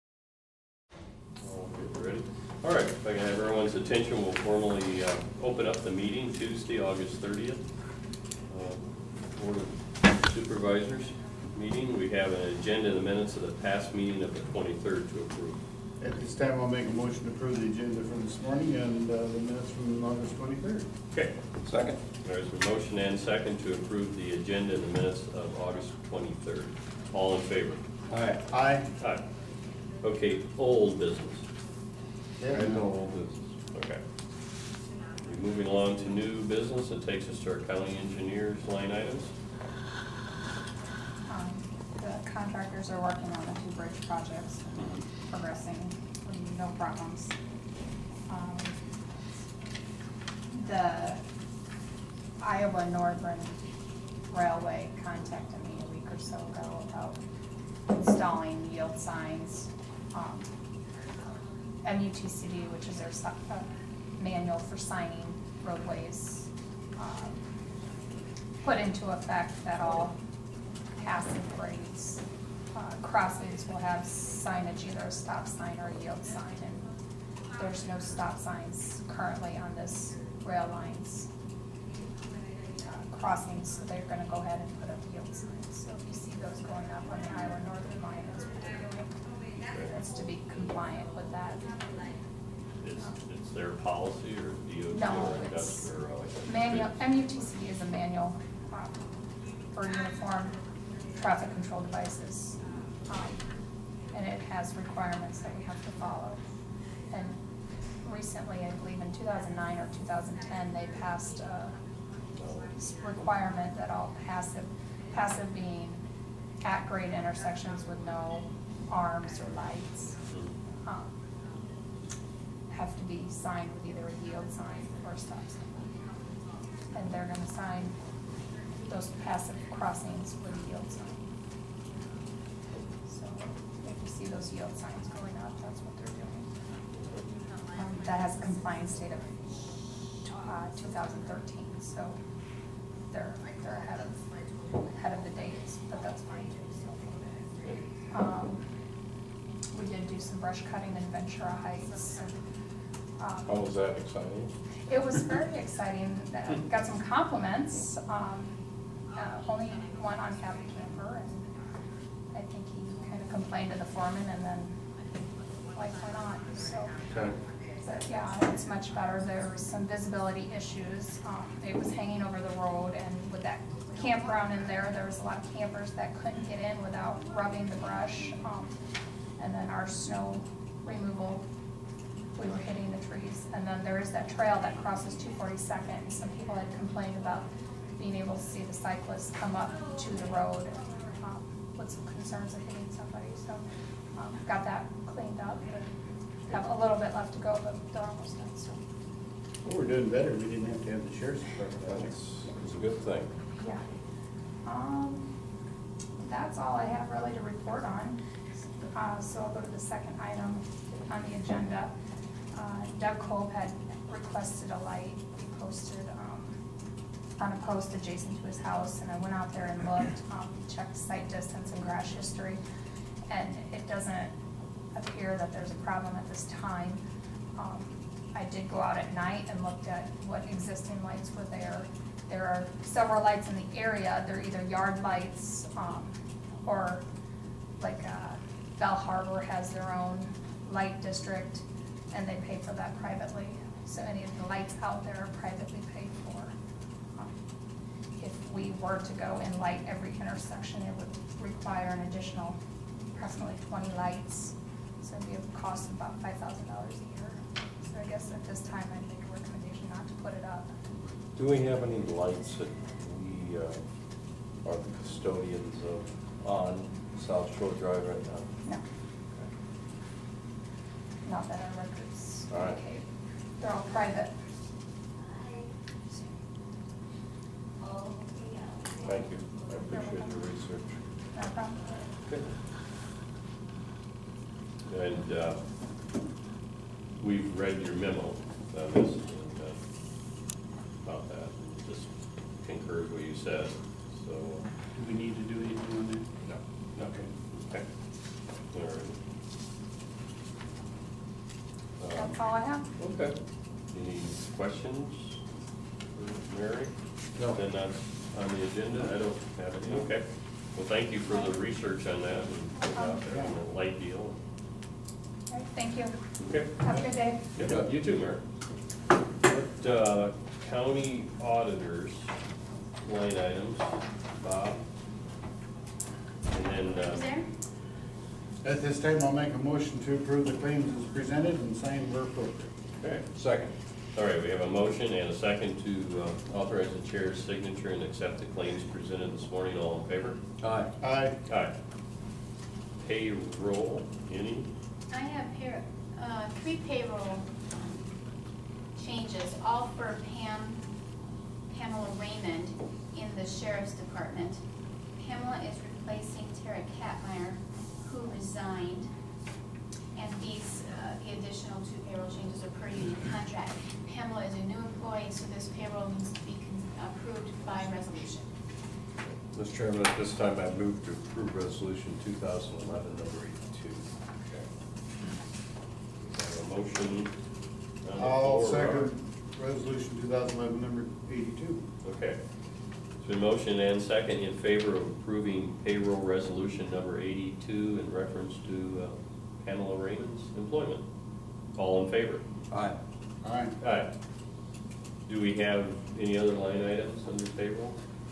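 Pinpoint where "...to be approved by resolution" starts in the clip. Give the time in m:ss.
6:06.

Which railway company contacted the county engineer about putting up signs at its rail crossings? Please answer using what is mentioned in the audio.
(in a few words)
Iowa Northern Railway.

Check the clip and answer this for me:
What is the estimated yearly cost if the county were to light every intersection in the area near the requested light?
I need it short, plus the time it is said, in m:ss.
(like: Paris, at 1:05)
$5,000, at 4:16.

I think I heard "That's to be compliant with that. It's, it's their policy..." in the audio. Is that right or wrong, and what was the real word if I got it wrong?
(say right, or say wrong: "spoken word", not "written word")
right.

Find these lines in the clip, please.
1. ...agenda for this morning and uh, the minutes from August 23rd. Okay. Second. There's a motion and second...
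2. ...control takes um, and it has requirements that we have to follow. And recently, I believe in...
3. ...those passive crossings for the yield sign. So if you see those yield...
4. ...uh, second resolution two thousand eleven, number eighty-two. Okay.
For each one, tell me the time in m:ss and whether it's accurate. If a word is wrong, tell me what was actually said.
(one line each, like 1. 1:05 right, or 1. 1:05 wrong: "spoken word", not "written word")
1. 0:17 right
2. 1:41 wrong: "devices", not "takes"
3. 2:08 right
4. 6:18 right.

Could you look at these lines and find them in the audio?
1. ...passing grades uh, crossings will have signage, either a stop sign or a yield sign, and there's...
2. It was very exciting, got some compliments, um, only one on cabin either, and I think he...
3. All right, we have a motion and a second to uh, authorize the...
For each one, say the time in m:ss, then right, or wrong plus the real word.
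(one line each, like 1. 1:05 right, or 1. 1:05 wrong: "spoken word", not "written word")
1. 1:11 right
2. 2:34 wrong: "camper", not "either"
3. 5:34 right.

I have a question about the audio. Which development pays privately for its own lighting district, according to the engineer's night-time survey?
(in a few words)
Bell Harbor.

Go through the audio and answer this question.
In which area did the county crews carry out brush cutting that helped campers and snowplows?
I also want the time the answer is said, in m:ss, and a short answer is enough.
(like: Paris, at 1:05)
Ventura Heights, at 2:31.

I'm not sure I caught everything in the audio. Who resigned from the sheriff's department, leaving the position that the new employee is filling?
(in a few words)
Tara Katmeyer.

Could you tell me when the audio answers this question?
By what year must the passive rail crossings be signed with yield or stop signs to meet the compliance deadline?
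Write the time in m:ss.
2:20.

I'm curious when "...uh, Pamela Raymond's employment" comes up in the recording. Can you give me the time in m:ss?
6:29.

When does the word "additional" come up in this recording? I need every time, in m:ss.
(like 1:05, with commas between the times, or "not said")
4:12, 6:01.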